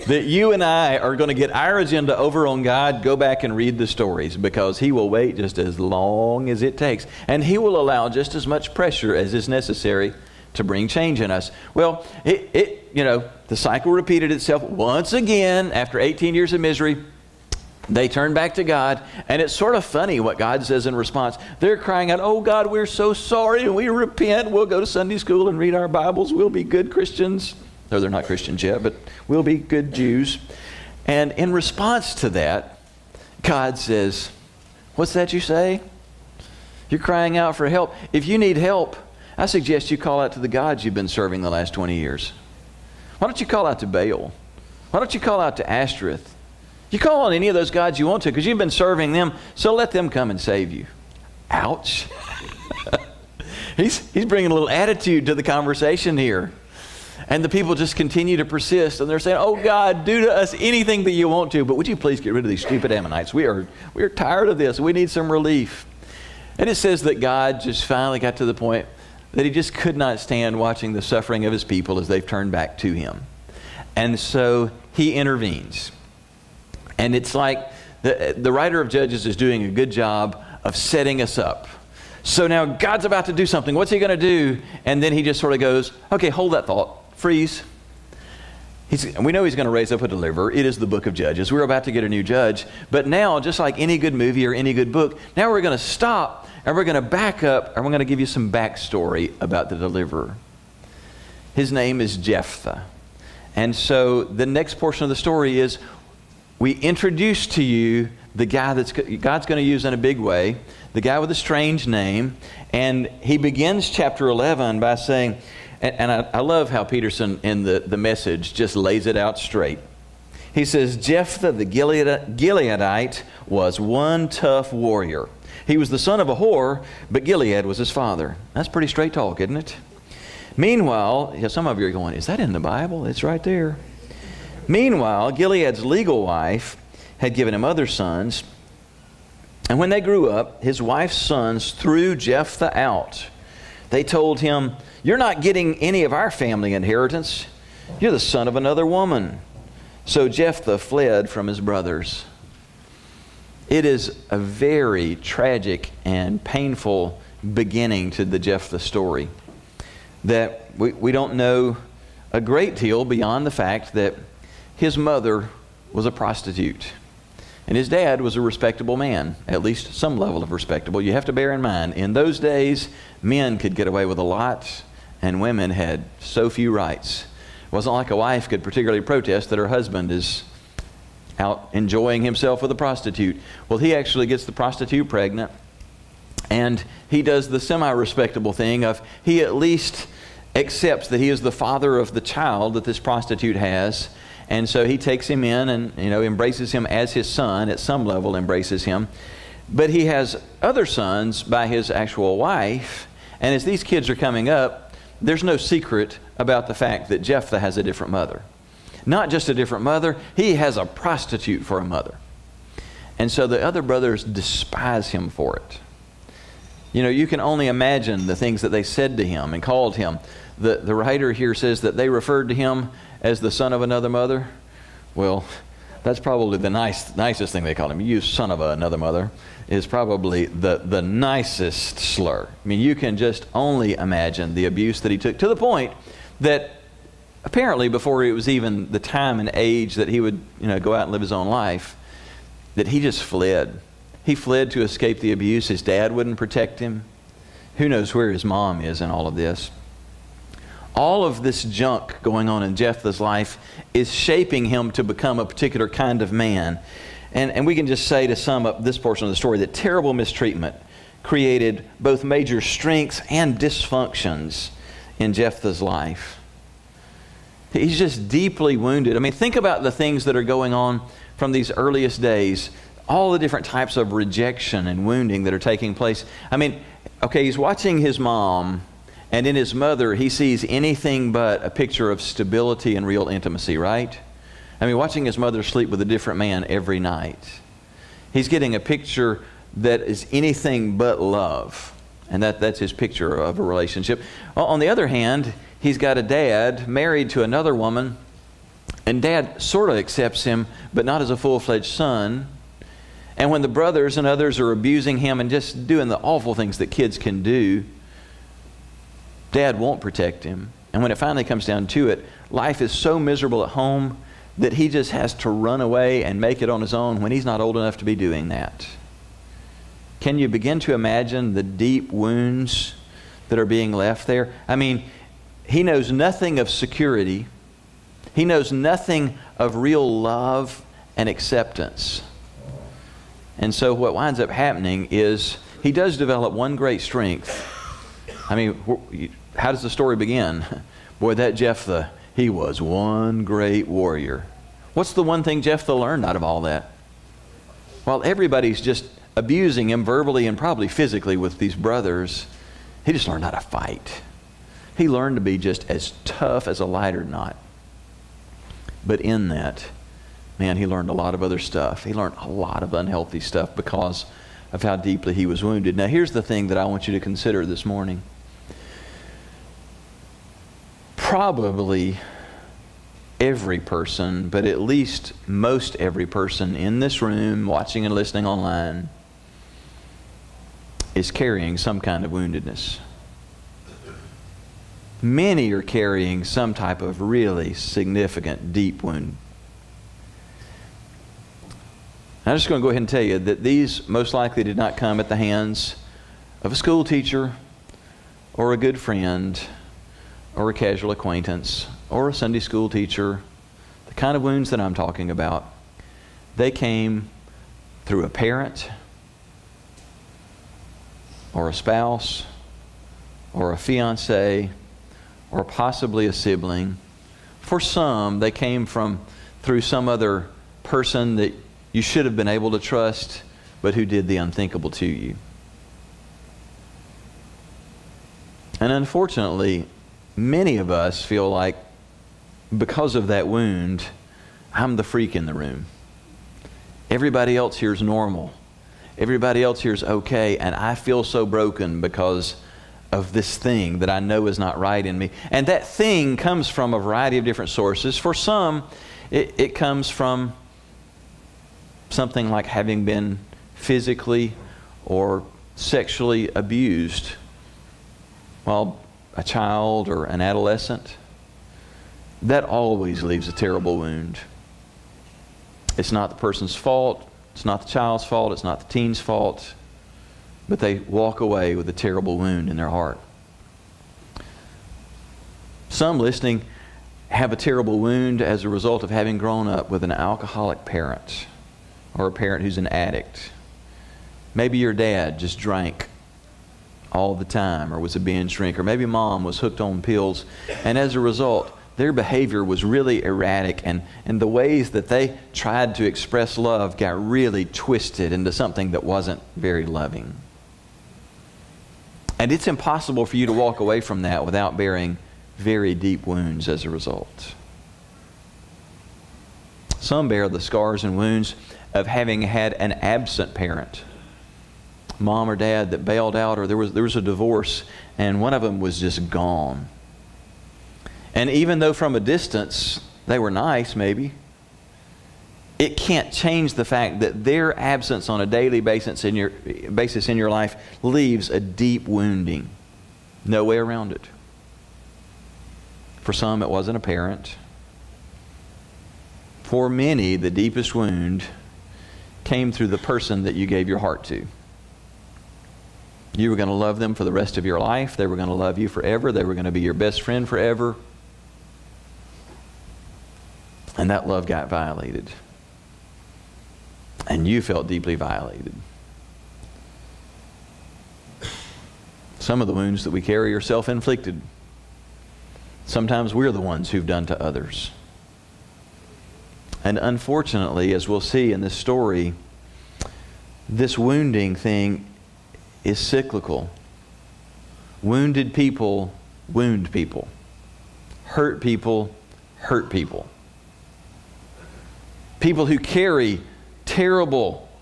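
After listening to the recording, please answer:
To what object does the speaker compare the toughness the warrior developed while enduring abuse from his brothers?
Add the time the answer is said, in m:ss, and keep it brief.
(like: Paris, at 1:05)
A lighter knot, at 5:56.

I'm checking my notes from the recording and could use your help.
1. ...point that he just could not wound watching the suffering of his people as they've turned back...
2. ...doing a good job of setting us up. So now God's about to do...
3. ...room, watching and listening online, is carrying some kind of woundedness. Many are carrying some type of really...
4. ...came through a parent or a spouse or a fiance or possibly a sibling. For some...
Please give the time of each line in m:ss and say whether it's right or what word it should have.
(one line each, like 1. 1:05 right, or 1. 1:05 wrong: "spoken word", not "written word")
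1. 1:08 wrong: "stand", not "wound"
2. 1:19 right
3. 6:17 right
4. 6:46 right.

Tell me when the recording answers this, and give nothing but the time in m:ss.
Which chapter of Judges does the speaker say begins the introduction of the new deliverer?
1:53.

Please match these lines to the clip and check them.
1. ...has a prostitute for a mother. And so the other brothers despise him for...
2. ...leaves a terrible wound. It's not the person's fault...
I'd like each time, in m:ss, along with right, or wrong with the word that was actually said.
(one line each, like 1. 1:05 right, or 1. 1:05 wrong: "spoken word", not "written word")
1. 3:30 right
2. 7:43 right.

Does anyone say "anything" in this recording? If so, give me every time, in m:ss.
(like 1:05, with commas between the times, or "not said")
1:00, 4:40, 4:50.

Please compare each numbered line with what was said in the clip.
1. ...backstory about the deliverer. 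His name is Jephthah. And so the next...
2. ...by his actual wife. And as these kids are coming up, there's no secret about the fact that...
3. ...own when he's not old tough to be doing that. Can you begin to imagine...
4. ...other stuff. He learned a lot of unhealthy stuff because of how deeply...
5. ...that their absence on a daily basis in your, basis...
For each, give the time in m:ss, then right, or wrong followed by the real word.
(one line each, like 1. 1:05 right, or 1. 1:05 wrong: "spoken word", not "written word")
1. 1:38 right
2. 3:21 right
3. 5:16 wrong: "enough", not "tough"
4. 6:01 right
5. 8:47 right.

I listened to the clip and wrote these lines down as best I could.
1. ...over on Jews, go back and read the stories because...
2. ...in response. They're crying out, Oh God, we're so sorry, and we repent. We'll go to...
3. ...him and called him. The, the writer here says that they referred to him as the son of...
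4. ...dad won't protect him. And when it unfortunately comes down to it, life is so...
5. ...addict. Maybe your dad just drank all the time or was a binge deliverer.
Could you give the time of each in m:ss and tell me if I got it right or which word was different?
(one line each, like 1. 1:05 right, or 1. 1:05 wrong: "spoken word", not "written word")
1. 0:02 wrong: "God", not "Jews"
2. 0:20 right
3. 3:39 right
4. 5:09 wrong: "finally", not "unfortunately"
5. 8:02 wrong: "drinker", not "deliverer".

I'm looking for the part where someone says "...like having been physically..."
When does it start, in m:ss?
7:32.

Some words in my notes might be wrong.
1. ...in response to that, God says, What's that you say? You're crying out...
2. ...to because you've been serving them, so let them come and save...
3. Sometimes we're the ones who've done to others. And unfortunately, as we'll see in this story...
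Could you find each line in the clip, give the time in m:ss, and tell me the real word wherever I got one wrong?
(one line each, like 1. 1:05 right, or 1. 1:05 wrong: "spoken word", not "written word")
1. 0:31 right
2. 0:48 right
3. 9:25 right.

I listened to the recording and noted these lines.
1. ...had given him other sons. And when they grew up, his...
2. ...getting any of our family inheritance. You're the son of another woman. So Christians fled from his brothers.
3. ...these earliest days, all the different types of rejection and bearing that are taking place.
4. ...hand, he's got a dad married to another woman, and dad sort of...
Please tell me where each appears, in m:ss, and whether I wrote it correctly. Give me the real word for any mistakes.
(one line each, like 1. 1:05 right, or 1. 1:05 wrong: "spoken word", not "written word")
1. 2:17 right
2. 2:25 wrong: "Jephthah", not "Christians"
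3. 4:31 wrong: "wounding", not "bearing"
4. 4:55 right.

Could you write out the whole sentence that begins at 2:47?
And his dad was a respectable man, at least some level of respectable.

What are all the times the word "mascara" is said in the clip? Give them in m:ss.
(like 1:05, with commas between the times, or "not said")
not said.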